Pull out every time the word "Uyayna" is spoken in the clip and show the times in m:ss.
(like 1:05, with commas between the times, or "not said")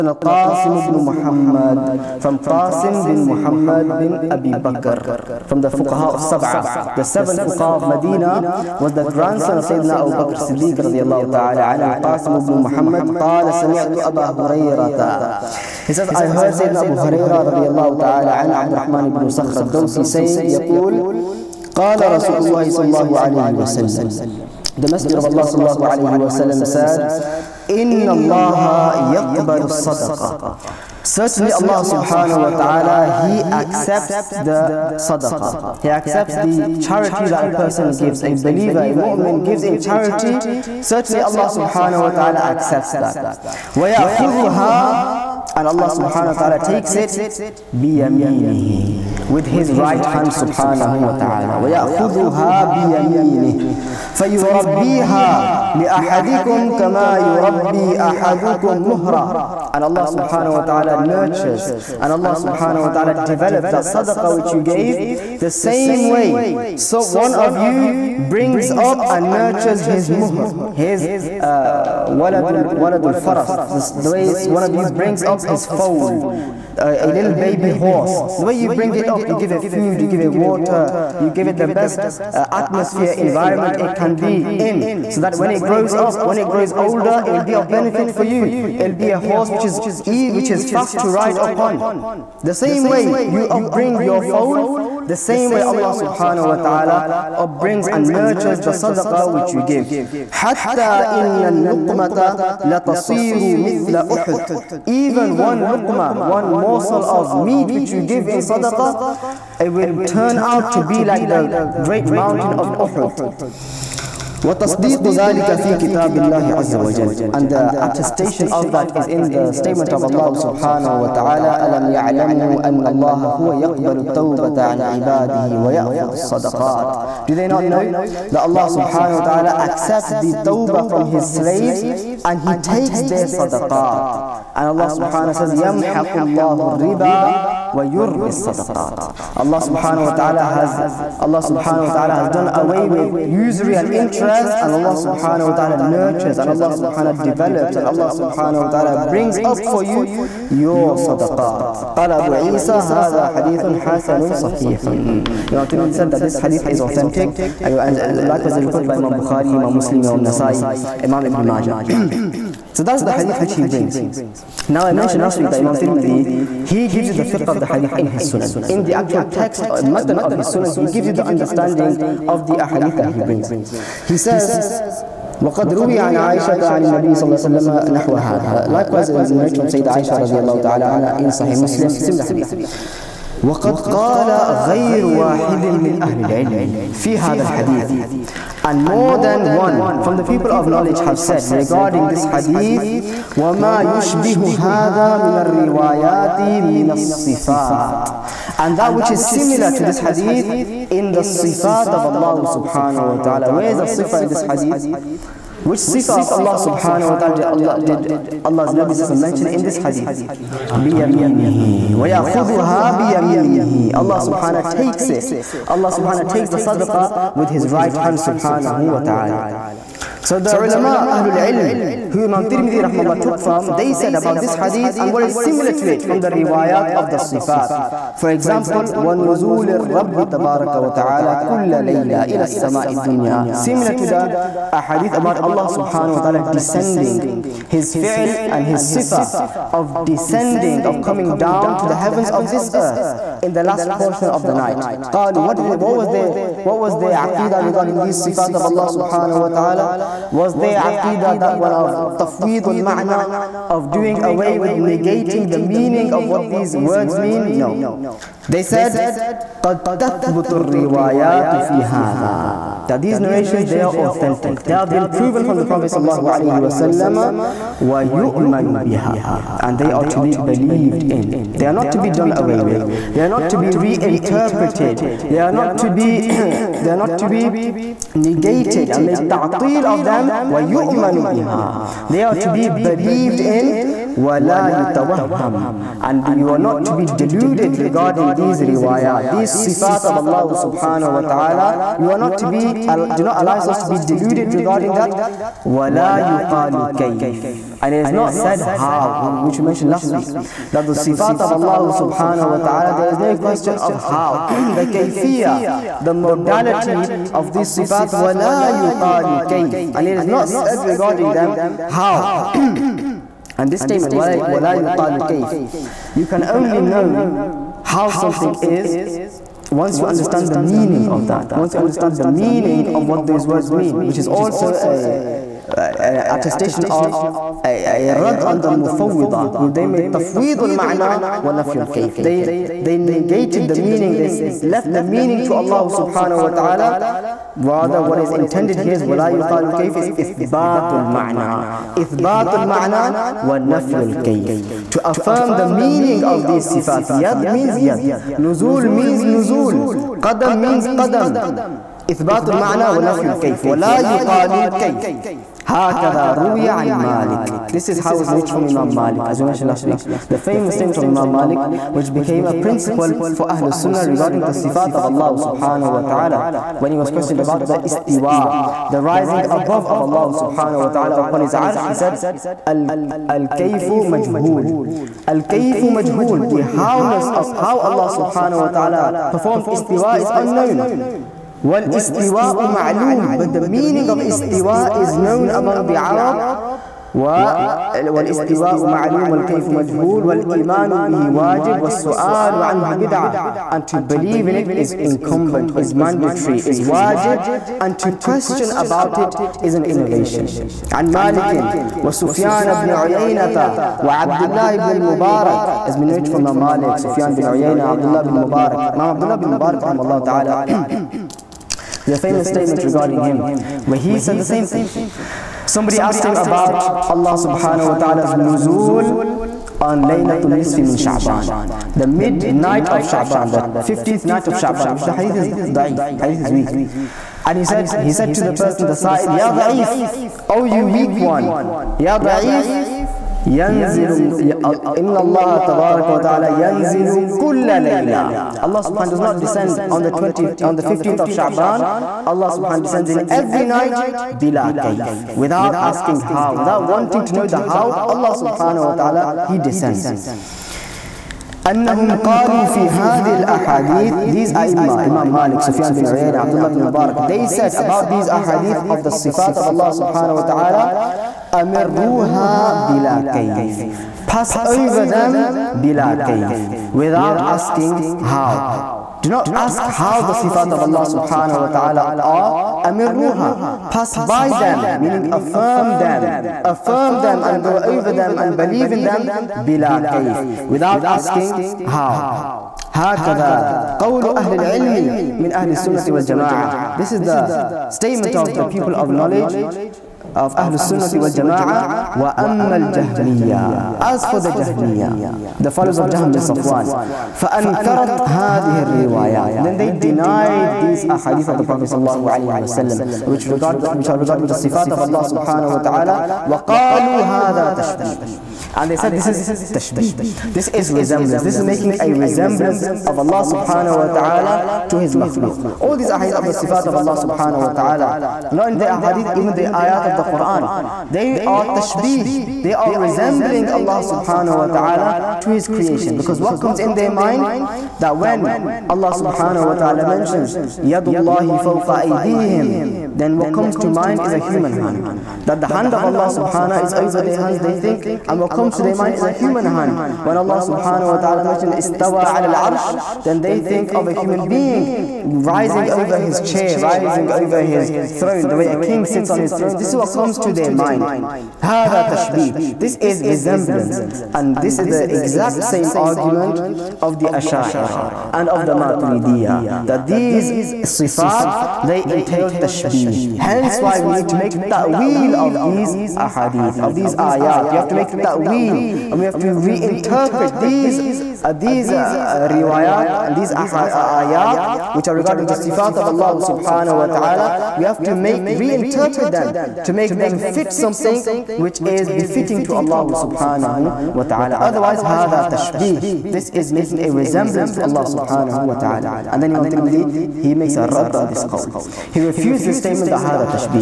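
6:47, 7:36.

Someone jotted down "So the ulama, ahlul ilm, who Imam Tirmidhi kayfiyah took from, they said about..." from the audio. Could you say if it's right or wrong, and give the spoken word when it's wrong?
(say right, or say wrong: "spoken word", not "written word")
wrong: "rahmallah", not "kayfiyah".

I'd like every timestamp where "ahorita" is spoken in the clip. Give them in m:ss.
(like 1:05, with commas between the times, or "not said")
not said.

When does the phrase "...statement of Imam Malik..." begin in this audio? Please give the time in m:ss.
6:00.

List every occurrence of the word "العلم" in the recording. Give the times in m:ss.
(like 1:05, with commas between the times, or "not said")
3:06, 8:04.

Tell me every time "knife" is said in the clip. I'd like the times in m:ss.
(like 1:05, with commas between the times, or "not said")
not said.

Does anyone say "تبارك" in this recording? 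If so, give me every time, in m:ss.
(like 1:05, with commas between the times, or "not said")
3:50, 7:15.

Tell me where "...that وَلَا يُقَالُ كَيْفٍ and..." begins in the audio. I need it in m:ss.
4:54.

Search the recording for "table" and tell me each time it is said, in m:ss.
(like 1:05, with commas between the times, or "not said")
not said.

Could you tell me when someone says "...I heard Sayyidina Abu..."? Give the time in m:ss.
0:16.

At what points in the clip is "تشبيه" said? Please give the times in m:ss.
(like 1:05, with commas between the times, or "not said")
8:27, 9:12, 9:45.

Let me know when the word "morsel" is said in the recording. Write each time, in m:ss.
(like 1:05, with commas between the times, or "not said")
1:46.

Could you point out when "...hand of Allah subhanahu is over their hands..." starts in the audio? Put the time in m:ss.
8:55.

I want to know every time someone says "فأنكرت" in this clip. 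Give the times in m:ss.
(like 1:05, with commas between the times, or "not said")
8:17.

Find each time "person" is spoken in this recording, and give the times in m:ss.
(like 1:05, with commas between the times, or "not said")
0:37, 7:08.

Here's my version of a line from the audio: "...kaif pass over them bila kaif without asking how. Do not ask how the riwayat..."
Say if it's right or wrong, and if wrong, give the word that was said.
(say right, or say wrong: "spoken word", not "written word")
wrong: "sifat", not "riwayat".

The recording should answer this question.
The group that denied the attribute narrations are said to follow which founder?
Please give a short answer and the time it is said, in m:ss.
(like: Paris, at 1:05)
Jahm bin Safwan, at 8:16.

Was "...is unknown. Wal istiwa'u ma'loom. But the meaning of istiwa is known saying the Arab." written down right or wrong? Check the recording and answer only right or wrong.
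wrong.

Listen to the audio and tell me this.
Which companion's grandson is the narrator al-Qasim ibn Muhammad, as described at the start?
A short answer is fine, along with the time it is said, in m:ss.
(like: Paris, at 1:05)
Abu Bakr Siddiq, at 0:10.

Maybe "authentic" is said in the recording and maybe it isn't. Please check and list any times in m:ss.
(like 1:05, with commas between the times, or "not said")
2:36, 4:23.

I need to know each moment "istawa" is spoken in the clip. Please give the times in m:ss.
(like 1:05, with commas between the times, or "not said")
9:01.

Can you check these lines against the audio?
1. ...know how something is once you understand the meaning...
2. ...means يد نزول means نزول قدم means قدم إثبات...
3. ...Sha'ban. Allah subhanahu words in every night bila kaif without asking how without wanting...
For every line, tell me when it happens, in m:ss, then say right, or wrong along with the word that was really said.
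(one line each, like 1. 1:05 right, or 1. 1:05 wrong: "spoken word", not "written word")
1. 5:16 right
2. 5:47 right
3. 7:21 wrong: "descends", not "words".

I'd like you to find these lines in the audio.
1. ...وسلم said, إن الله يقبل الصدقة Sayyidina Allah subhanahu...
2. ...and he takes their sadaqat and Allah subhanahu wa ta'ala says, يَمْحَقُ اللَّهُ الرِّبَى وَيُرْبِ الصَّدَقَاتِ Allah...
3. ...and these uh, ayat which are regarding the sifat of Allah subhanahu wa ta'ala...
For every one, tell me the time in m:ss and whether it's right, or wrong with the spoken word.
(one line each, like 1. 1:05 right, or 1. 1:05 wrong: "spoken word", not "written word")
1. 0:26 wrong: "Certainly", not "Sayyidina"
2. 2:12 right
3. 9:33 right.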